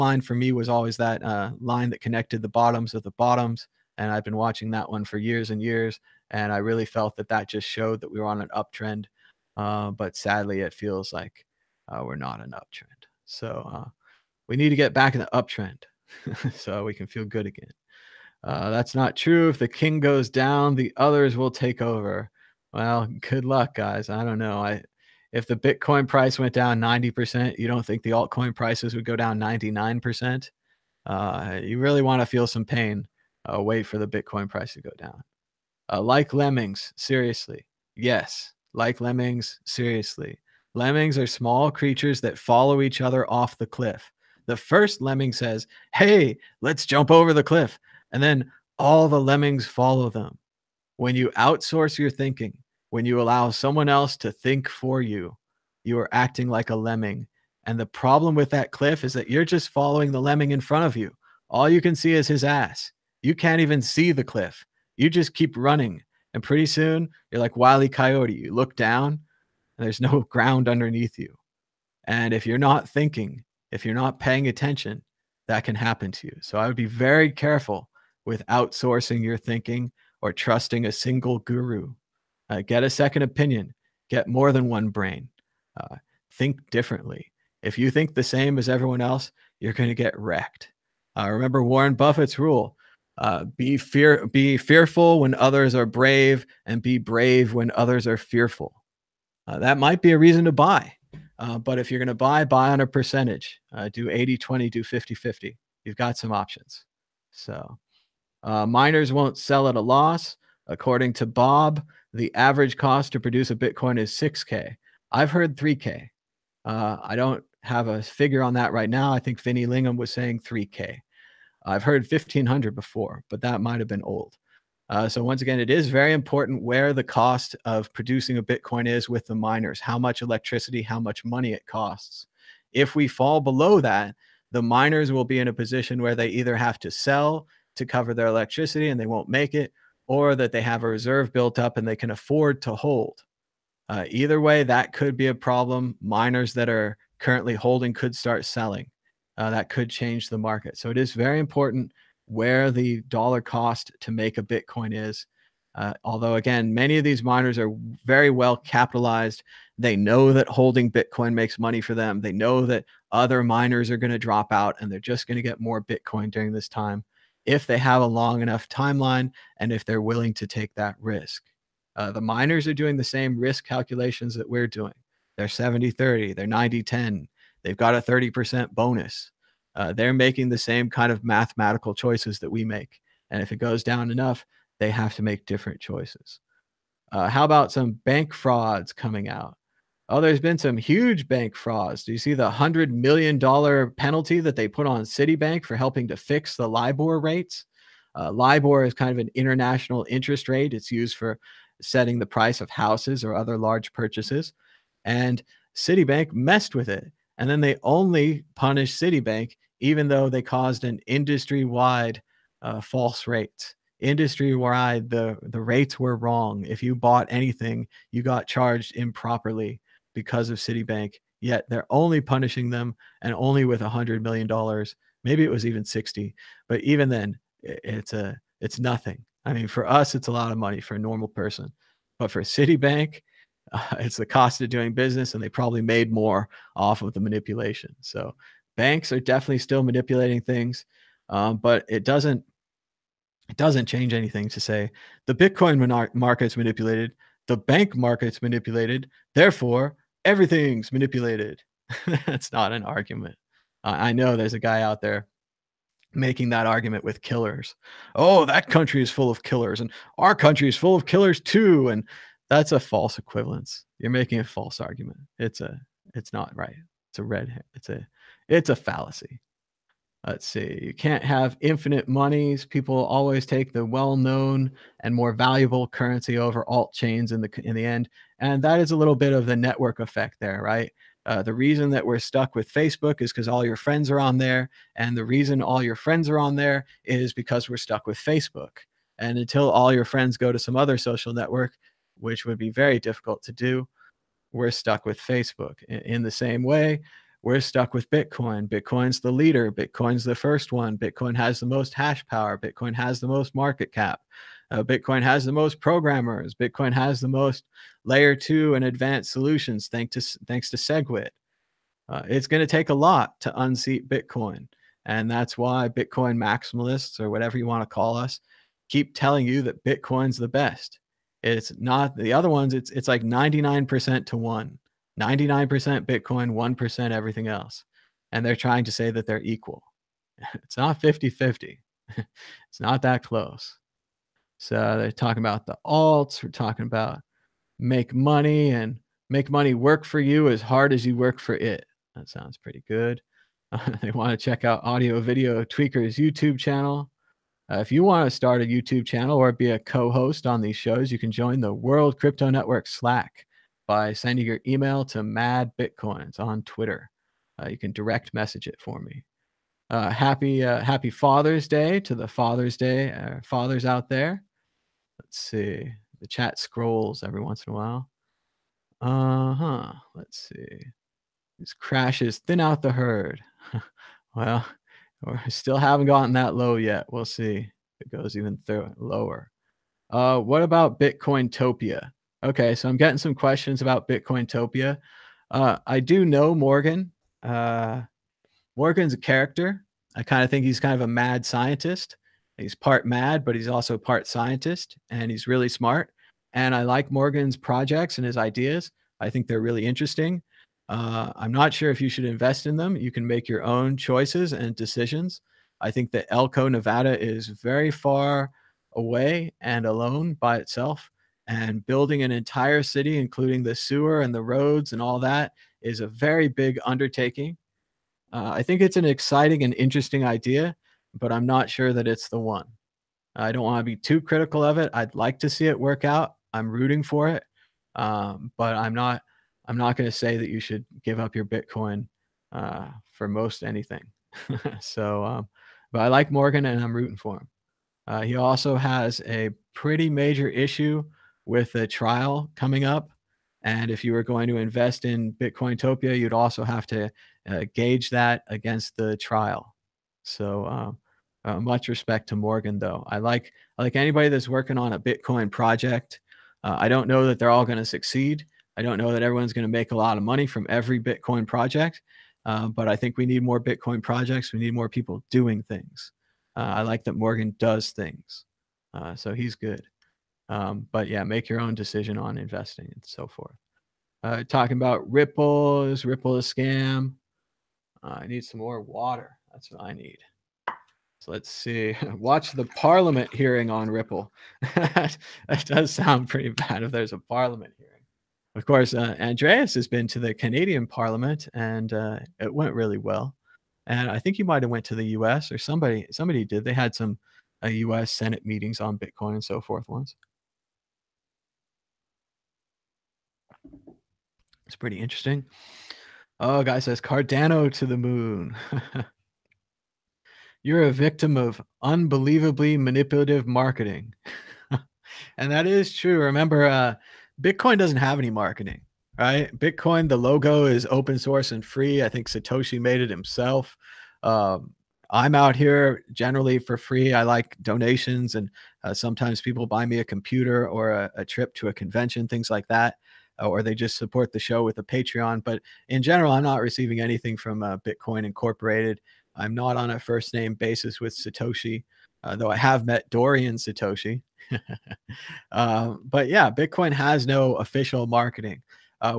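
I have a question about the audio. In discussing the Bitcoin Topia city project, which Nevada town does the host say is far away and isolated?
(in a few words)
Elko.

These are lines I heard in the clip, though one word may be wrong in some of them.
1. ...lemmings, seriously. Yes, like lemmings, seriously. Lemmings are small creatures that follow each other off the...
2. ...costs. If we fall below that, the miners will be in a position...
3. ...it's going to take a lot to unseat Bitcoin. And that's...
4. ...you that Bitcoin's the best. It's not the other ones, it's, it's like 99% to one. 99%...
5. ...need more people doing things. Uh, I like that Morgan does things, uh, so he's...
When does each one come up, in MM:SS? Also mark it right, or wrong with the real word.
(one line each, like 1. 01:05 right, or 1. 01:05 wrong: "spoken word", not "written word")
1. 00:36 right
2. 02:11 right
3. 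05:12 right
4. 05:19 right
5. 07:44 right.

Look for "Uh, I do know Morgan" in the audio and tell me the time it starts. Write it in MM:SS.
06:25.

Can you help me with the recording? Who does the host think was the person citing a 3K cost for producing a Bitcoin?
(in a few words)
Vinny Lingham.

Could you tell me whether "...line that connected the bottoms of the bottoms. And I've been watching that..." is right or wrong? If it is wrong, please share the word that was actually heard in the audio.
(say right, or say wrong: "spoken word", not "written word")
right.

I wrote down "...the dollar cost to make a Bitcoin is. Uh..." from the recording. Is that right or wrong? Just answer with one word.
right.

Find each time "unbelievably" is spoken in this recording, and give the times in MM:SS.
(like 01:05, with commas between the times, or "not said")
08:31.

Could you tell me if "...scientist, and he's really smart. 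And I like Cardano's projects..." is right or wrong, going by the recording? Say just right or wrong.
wrong.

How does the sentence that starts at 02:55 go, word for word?
They're 70 30, they're 90 10, they've got a 30% bonus.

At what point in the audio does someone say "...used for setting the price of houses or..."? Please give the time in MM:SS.
03:20.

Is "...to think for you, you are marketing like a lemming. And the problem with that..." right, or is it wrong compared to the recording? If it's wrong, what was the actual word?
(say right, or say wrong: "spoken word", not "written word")
wrong: "acting", not "marketing".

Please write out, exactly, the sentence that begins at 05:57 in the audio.
Uh, you can direct message it for me.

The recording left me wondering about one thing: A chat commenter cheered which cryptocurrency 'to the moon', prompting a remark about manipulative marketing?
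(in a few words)
Cardano.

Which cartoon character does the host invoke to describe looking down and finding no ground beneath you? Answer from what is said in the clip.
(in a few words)
Wiley Coyote.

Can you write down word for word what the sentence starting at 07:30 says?
So, um, uh, much respect to Morgan, though.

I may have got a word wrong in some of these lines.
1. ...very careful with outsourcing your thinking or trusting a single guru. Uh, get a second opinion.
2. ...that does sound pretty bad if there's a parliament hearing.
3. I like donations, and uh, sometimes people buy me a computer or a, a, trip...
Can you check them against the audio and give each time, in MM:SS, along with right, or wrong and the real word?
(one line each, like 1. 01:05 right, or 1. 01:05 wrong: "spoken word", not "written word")
1. 01:16 right
2. 08:04 right
3. 08:47 right.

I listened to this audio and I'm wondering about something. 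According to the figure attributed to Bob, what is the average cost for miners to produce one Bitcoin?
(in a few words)
6K.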